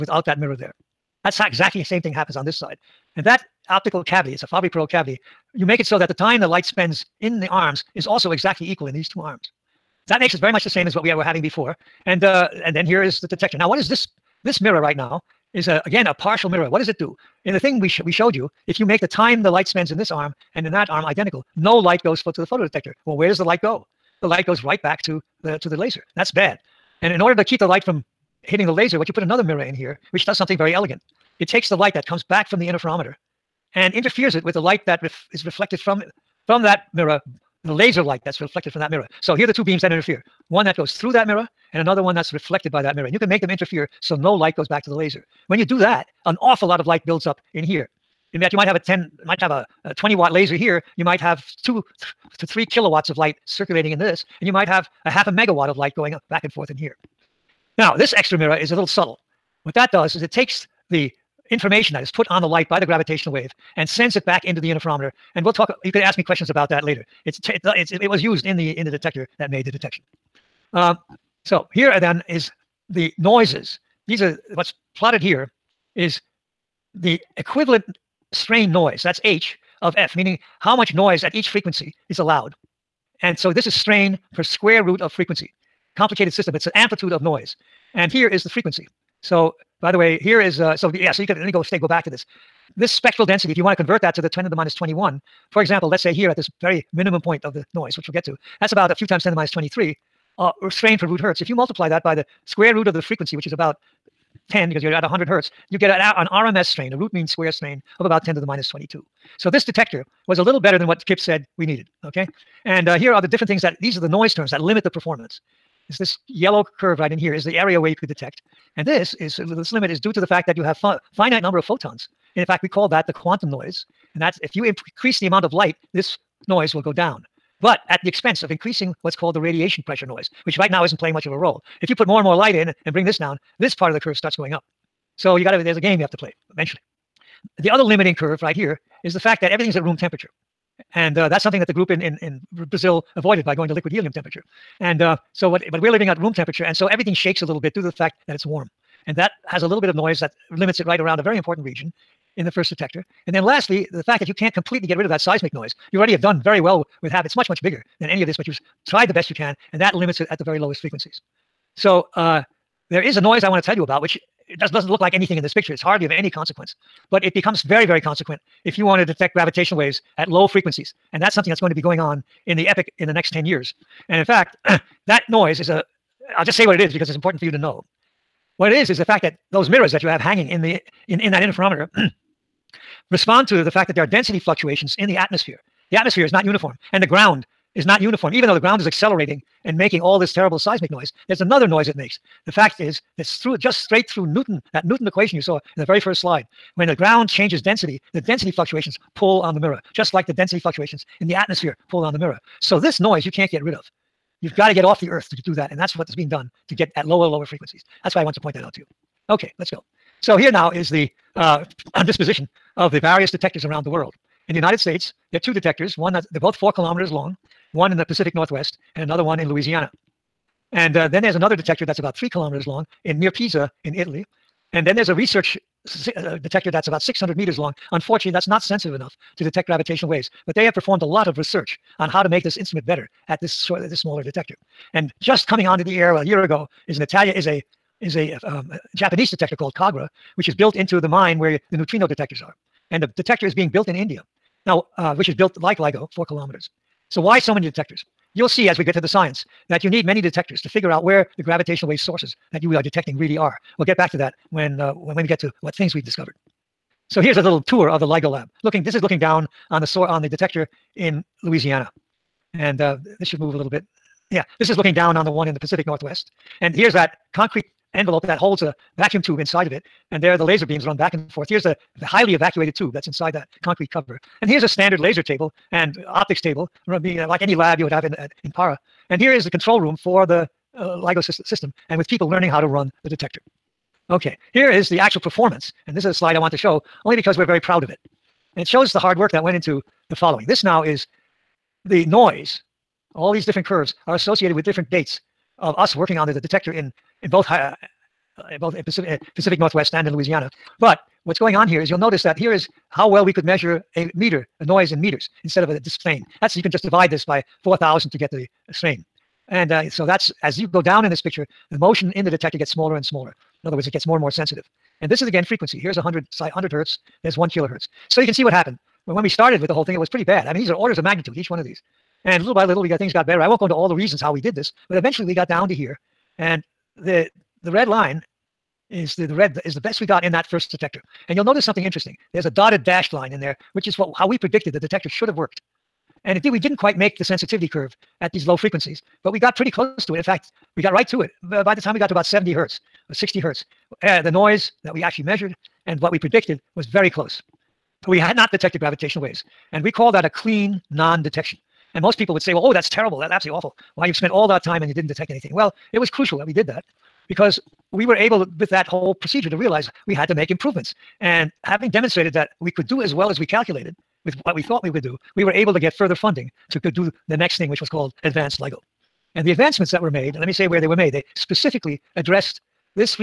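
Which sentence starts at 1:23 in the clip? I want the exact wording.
And so this is strain per square root of frequency.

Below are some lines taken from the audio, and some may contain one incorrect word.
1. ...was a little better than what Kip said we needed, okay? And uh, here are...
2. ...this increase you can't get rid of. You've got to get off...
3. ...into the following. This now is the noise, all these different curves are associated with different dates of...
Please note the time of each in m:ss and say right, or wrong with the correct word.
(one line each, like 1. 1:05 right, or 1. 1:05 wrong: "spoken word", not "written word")
1. 1:50 right
2. 3:22 wrong: "noise", not "increase"
3. 4:49 right.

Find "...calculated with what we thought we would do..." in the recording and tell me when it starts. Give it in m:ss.
6:03.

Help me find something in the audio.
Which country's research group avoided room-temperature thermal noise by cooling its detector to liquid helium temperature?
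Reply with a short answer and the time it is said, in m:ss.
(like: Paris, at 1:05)
Brazil, at 2:22.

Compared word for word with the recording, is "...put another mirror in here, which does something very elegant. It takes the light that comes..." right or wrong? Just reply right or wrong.
right.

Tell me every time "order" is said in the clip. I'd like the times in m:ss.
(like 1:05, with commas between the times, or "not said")
0:27, 5:20.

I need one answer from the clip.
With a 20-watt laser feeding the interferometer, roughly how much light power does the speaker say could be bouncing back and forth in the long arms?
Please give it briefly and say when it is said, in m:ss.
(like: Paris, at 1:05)
half a megawatt, at 0:55.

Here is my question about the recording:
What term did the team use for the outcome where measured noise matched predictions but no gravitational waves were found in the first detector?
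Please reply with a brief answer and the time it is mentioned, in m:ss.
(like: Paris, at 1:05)
clean non-detection, at 5:50.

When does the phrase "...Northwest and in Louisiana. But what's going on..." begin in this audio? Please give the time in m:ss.
4:59.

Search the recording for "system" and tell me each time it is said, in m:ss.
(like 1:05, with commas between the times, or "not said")
1:26, 4:41.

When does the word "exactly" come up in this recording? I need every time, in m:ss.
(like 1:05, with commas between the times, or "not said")
0:01, 0:08.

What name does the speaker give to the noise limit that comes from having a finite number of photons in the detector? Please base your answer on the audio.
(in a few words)
quantum noise.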